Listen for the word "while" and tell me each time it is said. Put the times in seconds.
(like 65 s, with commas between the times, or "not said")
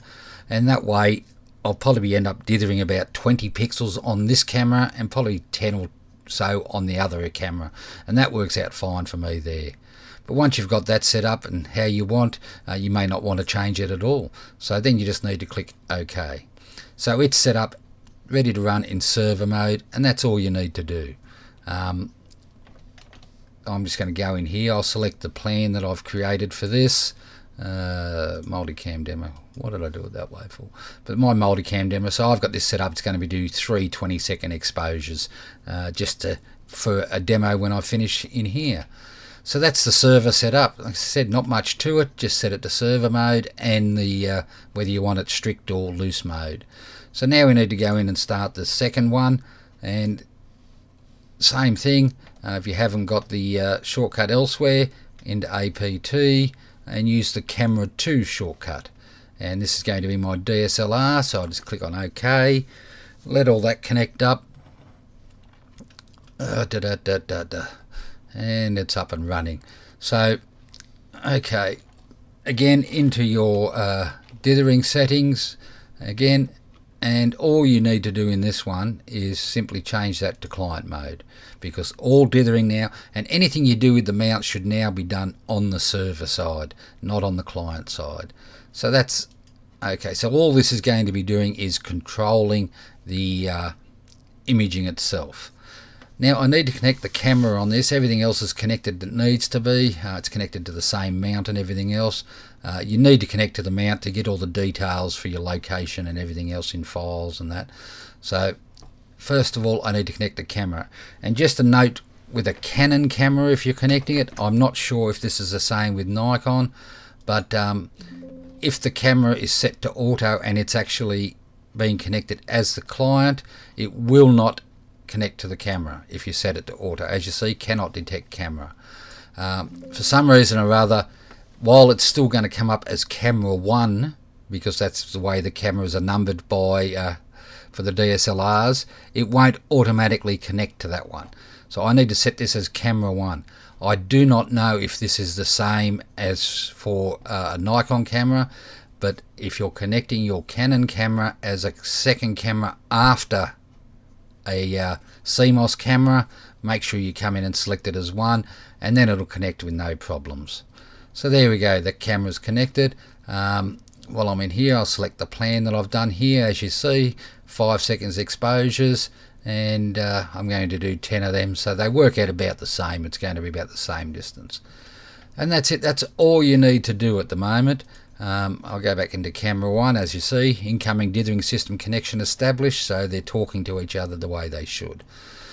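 131 s, 164 s.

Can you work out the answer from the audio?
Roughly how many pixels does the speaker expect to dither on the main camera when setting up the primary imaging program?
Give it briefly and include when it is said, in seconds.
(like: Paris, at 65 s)
20, at 3 s.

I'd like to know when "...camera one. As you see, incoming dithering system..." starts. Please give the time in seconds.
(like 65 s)
179 s.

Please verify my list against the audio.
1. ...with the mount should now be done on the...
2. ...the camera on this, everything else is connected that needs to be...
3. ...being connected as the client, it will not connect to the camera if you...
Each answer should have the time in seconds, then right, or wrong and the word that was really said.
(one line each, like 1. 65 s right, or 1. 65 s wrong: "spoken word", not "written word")
1. 83 s right
2. 97 s right
3. 121 s right.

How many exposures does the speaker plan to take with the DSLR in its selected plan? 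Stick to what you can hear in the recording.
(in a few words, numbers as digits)
10.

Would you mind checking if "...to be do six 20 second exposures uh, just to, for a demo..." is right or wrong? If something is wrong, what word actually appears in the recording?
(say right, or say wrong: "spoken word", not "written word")
wrong: "three", not "six".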